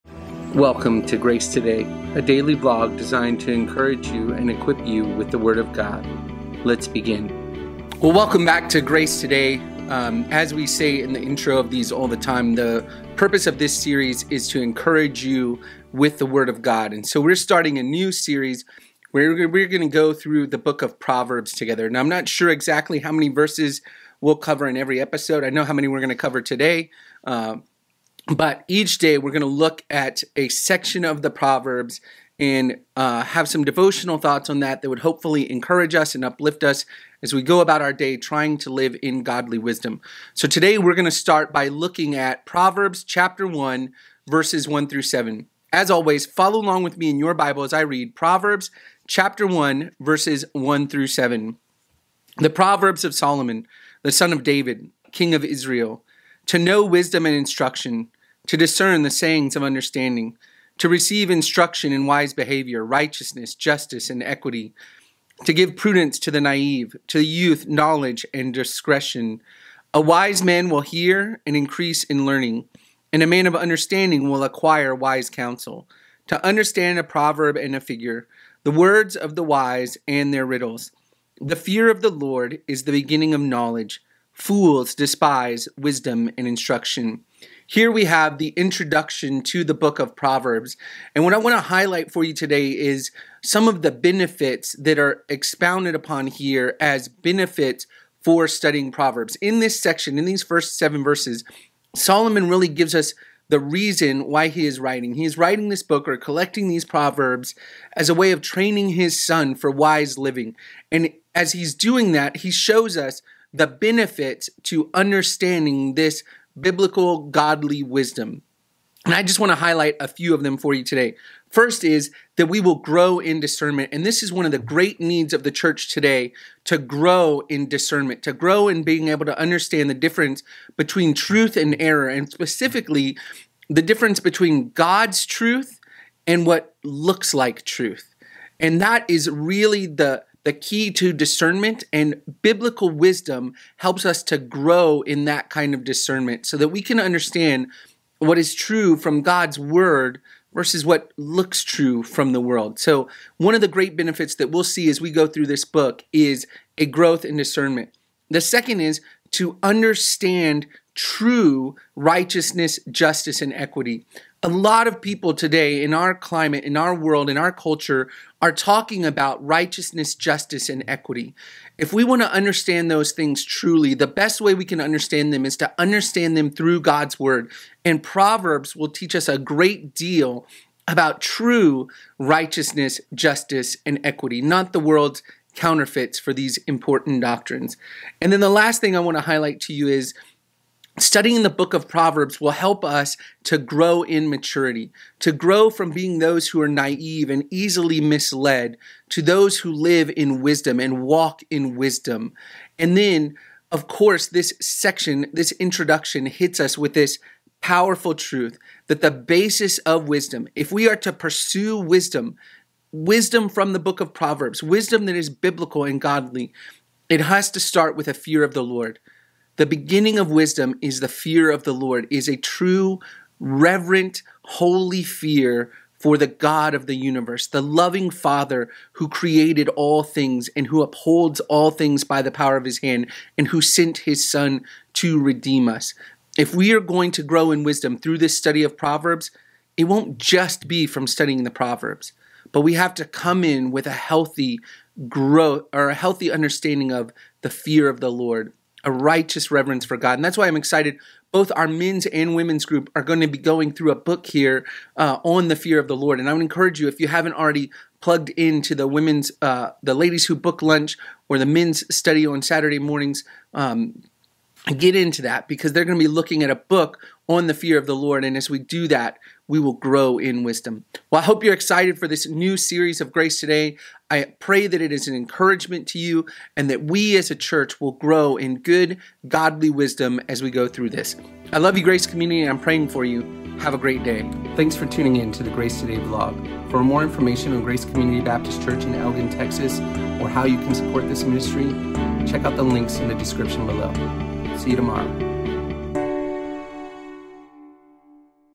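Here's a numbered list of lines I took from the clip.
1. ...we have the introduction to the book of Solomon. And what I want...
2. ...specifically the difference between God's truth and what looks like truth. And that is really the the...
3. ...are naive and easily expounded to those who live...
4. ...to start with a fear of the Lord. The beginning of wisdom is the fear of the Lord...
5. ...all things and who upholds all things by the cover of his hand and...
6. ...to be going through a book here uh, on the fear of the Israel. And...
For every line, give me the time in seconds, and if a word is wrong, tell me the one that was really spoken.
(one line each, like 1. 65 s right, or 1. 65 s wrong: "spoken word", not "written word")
1. 87 s wrong: "Proverbs", not "Solomon"
2. 132 s right
3. 196 s wrong: "misled", not "expounded"
4. 217 s right
5. 229 s wrong: "power", not "cover"
6. 253 s wrong: "Lord", not "Israel".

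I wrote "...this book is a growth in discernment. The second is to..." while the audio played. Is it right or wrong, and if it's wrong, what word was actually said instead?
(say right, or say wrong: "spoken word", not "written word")
right.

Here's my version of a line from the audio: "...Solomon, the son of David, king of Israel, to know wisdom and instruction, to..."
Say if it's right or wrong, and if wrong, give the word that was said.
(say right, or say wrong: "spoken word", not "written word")
right.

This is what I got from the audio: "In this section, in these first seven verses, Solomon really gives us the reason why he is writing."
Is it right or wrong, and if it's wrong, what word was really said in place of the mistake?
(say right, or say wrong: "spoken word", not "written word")
right.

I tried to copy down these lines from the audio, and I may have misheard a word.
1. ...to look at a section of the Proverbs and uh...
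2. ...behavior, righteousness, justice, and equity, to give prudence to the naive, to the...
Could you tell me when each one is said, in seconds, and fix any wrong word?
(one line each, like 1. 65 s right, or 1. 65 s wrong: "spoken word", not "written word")
1. 29 s right
2. 62 s right.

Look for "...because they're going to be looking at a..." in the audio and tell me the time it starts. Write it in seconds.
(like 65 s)
265 s.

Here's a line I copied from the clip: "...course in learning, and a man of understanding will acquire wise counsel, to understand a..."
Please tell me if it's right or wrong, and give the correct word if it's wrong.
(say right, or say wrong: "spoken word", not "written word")
wrong: "increase", not "course".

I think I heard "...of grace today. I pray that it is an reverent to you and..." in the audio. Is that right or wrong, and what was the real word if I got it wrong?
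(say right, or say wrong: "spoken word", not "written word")
wrong: "encouragement", not "reverent".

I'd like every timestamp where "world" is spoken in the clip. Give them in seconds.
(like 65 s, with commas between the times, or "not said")
152 s, 166 s, 184 s.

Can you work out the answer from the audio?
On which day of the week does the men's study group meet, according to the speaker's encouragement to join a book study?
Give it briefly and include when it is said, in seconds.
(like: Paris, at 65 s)
Saturday, at 262 s.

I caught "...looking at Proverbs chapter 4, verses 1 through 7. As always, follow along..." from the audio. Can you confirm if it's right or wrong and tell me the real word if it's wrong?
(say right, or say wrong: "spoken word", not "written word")
wrong: "1", not "4".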